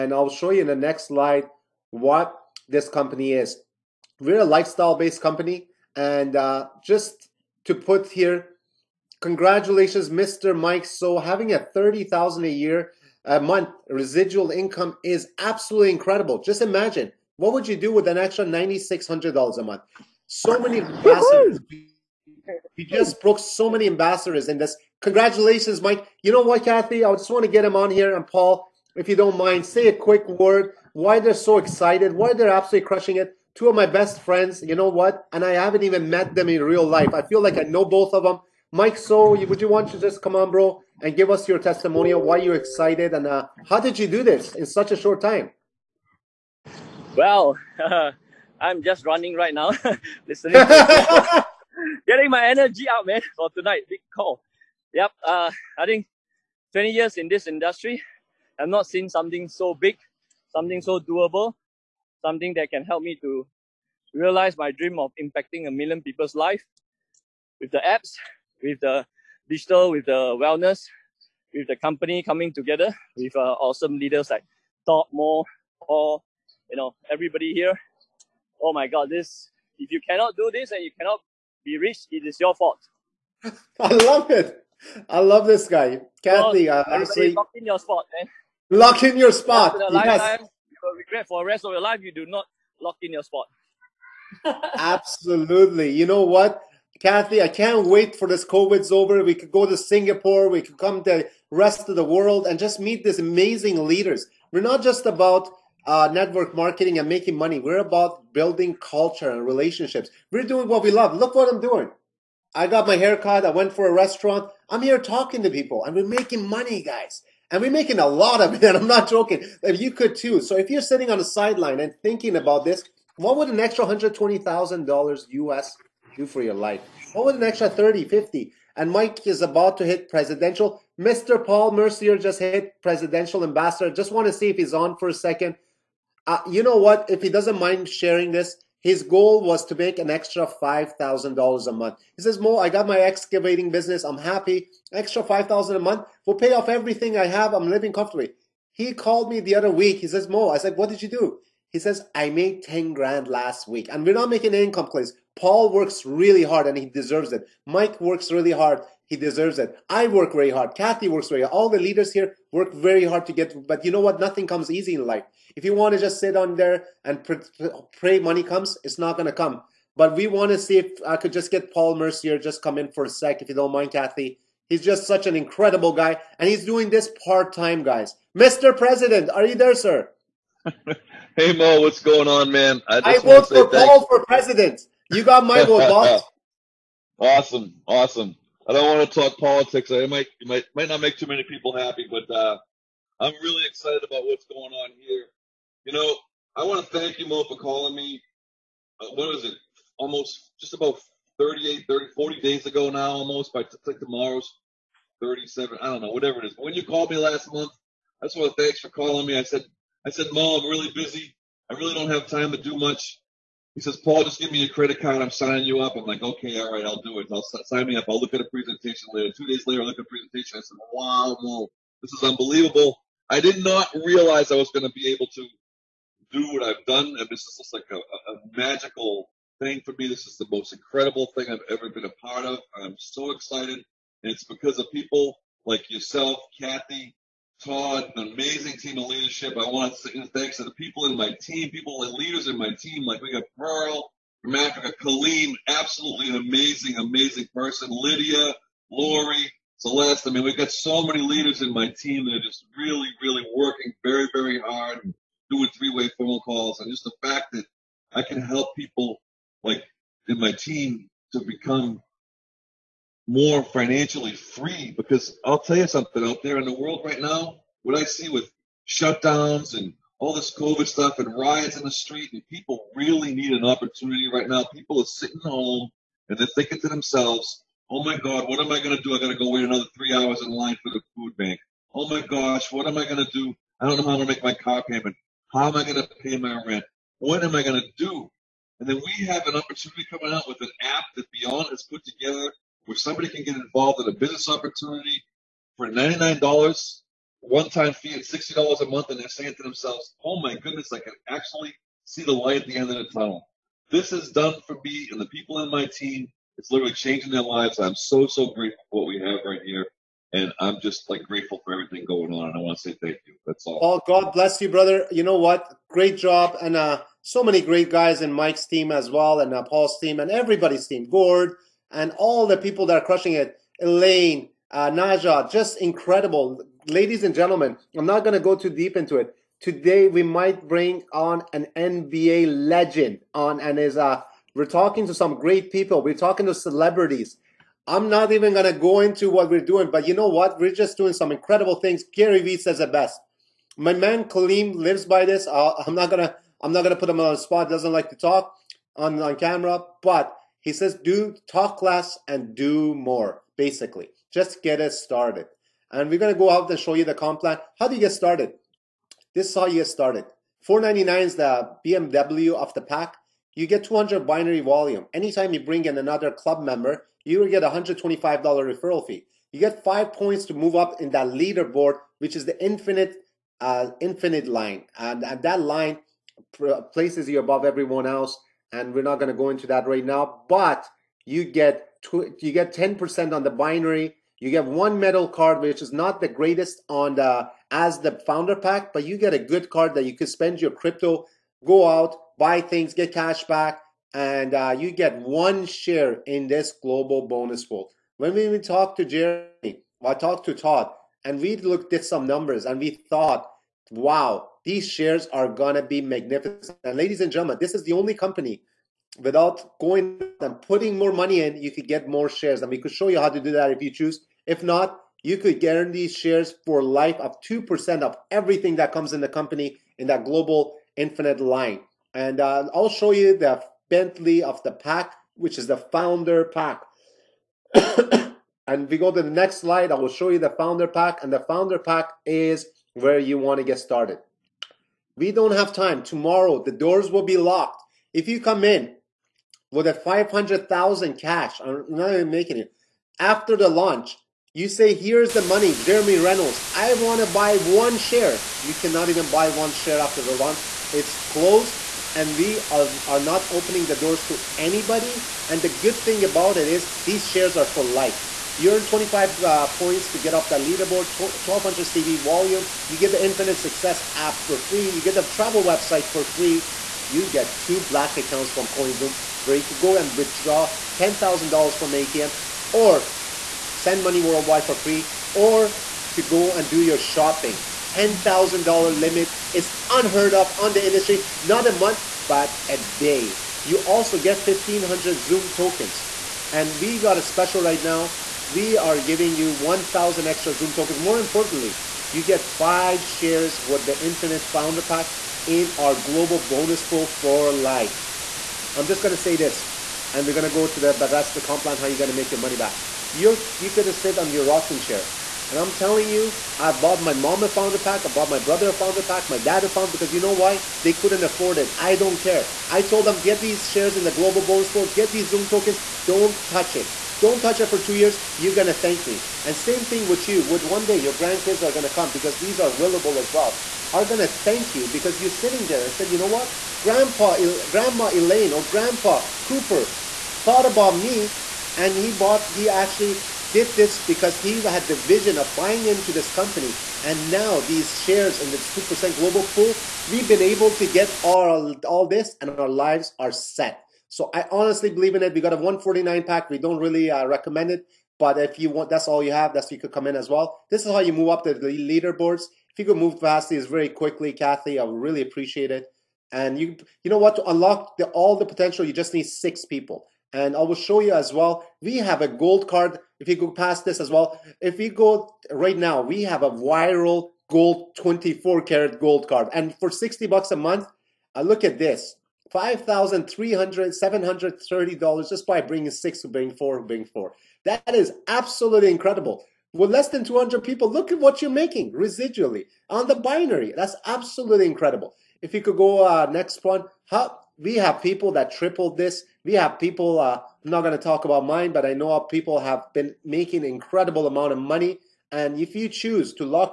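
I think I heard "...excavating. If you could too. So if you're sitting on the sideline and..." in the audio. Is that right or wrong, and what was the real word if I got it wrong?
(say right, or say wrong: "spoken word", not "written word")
wrong: "joking", not "excavating".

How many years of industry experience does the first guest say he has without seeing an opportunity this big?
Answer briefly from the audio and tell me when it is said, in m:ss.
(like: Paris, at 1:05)
20, at 0:56.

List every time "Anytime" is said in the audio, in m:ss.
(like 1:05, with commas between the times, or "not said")
6:05.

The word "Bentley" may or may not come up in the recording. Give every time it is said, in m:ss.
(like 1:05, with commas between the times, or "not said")
7:03.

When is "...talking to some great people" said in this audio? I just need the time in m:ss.
5:34.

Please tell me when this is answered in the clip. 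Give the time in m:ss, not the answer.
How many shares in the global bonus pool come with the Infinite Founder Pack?
8:12.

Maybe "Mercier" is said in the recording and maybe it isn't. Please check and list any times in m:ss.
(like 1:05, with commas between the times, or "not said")
2:11, 2:51.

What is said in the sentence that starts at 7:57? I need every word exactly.
$10,000 limit is unheard of on the industry, not a month, but a day.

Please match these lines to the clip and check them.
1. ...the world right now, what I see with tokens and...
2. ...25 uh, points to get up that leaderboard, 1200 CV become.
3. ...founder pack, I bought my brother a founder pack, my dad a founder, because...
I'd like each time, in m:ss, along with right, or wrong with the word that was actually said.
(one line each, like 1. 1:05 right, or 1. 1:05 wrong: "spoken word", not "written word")
1. 4:26 wrong: "shutdowns", not "tokens"
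2. 7:38 wrong: "volume", not "become"
3. 8:27 right.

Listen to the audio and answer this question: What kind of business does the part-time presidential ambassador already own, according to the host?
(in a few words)
Excavating business.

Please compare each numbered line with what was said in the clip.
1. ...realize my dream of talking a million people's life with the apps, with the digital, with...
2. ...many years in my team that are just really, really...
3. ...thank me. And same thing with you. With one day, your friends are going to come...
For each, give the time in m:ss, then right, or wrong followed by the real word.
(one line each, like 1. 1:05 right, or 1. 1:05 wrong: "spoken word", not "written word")
1. 1:04 wrong: "impacting", not "talking"
2. 4:11 wrong: "leaders", not "years"
3. 8:38 wrong: "grandkids", not "friends".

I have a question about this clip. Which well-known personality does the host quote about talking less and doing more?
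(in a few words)
Gary Vee.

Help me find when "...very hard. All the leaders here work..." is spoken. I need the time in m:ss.
2:41.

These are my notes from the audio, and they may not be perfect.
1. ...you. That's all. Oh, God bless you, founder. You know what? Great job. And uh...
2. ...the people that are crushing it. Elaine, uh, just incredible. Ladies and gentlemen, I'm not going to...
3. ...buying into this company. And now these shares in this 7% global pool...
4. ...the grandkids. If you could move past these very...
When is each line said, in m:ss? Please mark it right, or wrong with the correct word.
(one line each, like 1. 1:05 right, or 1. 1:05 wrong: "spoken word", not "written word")
1. 5:13 wrong: "brother", not "founder"
2. 5:22 right
3. 8:55 wrong: "2", not "7"
4. 9:11 wrong: "leaderboards", not "grandkids".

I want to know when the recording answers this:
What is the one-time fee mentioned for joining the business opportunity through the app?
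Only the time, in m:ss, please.
4:55.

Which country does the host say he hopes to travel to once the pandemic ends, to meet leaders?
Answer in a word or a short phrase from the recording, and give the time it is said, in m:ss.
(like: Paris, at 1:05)
Singapore, at 1:39.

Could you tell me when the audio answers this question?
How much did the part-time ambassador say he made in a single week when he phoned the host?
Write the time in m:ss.
2:32.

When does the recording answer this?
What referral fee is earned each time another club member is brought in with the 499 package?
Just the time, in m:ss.
6:07.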